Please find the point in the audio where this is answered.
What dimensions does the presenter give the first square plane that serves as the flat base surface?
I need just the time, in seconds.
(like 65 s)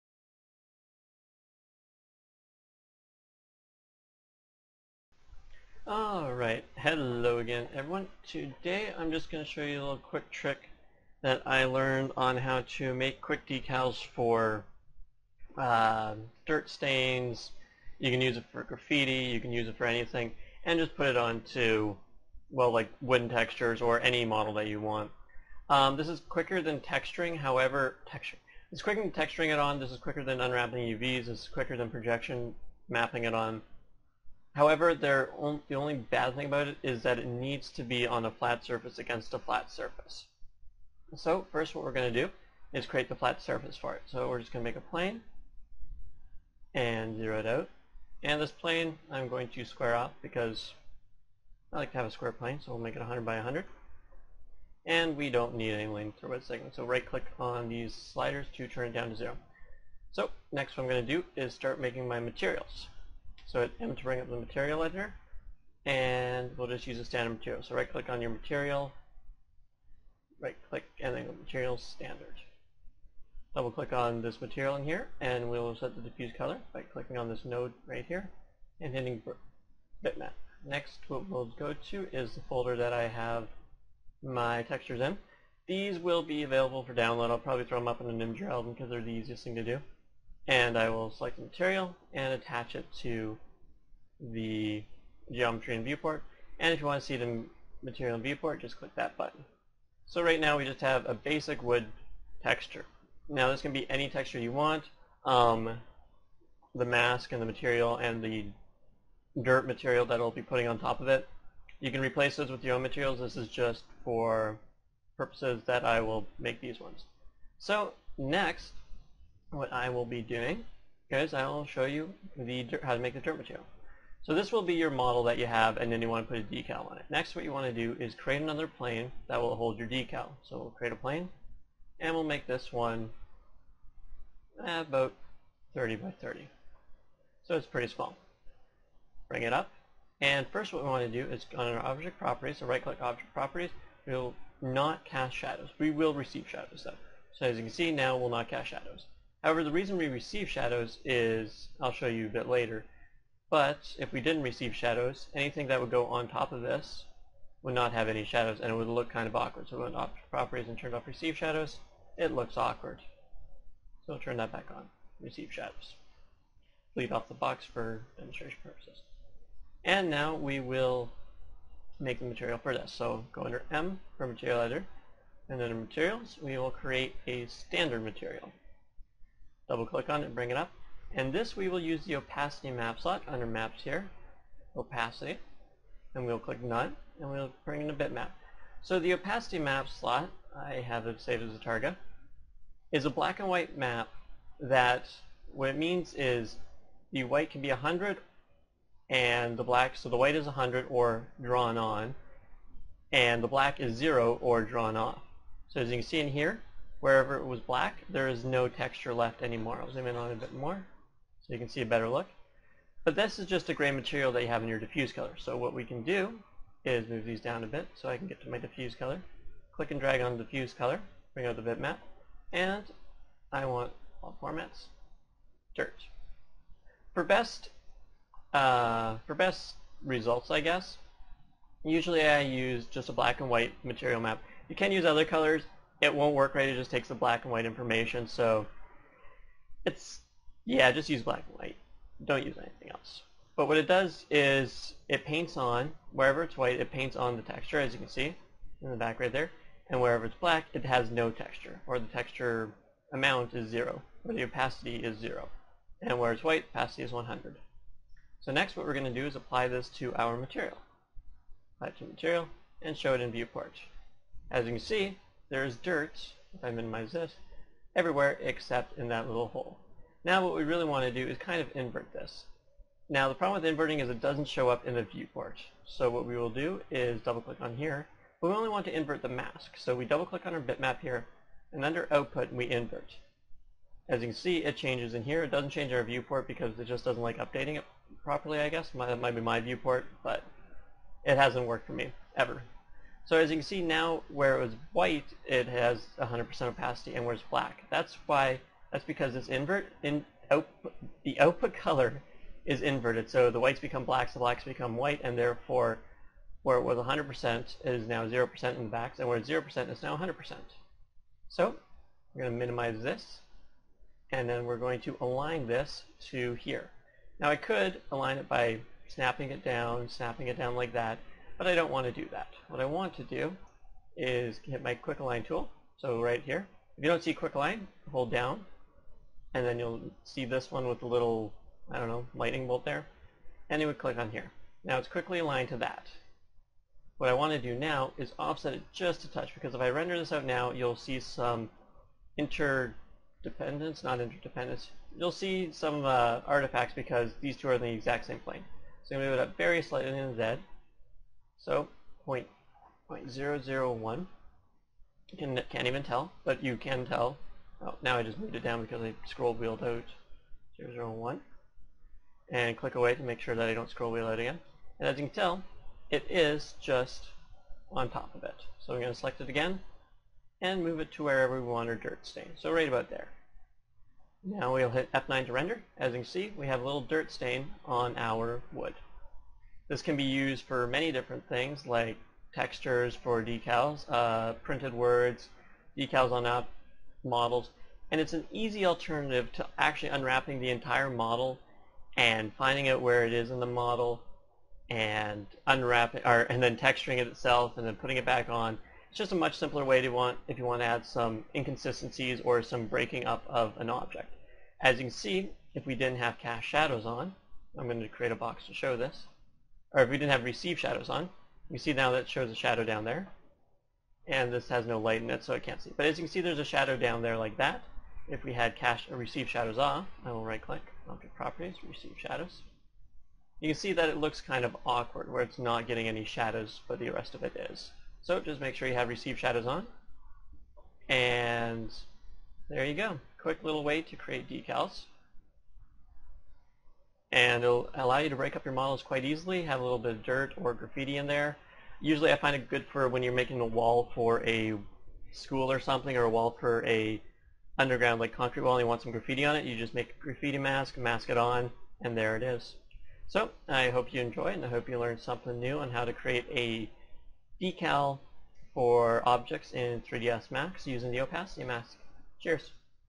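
52 s.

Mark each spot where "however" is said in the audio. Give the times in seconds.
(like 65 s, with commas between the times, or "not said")
27 s, 34 s, 149 s.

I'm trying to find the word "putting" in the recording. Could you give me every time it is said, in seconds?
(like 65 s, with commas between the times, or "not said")
110 s, 397 s.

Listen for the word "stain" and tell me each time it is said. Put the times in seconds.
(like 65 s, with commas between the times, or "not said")
16 s, 372 s, 377 s.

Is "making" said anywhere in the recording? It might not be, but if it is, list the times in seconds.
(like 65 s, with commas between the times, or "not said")
61 s, 443 s.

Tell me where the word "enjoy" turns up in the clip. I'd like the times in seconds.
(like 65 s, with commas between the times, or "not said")
454 s.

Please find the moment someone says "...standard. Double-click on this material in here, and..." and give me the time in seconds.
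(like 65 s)
71 s.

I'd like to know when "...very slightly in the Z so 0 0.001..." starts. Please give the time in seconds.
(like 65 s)
349 s.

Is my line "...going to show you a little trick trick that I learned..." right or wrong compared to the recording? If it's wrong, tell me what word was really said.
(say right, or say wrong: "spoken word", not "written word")
wrong: "quick", not "trick".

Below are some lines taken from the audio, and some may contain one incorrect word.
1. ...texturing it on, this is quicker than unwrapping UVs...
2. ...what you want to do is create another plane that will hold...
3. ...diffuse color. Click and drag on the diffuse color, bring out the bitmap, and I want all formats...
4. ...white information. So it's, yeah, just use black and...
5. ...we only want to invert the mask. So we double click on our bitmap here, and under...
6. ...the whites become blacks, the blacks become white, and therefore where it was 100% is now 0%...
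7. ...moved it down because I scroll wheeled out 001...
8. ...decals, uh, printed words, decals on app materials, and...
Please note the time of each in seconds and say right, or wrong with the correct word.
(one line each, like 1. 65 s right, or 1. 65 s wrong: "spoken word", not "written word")
1. 29 s right
2. 127 s right
3. 218 s right
4. 237 s right
5. 278 s right
6. 303 s right
7. 358 s right
8. 383 s wrong: "models", not "materials".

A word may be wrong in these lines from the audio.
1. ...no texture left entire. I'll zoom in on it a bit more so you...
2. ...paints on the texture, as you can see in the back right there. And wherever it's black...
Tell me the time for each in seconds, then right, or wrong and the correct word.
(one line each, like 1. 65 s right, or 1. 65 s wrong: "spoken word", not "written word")
1. 208 s wrong: "anymore", not "entire"
2. 246 s right.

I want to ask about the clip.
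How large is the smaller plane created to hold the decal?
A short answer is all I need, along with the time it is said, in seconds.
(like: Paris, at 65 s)
30 by 30, at 135 s.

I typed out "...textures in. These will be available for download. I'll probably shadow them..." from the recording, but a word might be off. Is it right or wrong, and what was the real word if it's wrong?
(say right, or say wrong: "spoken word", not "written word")
wrong: "throw", not "shadow".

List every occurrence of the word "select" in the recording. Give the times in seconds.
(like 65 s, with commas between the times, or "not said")
91 s, 369 s.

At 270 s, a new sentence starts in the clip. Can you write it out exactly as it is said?
Now what we really want to do is kind of invert this.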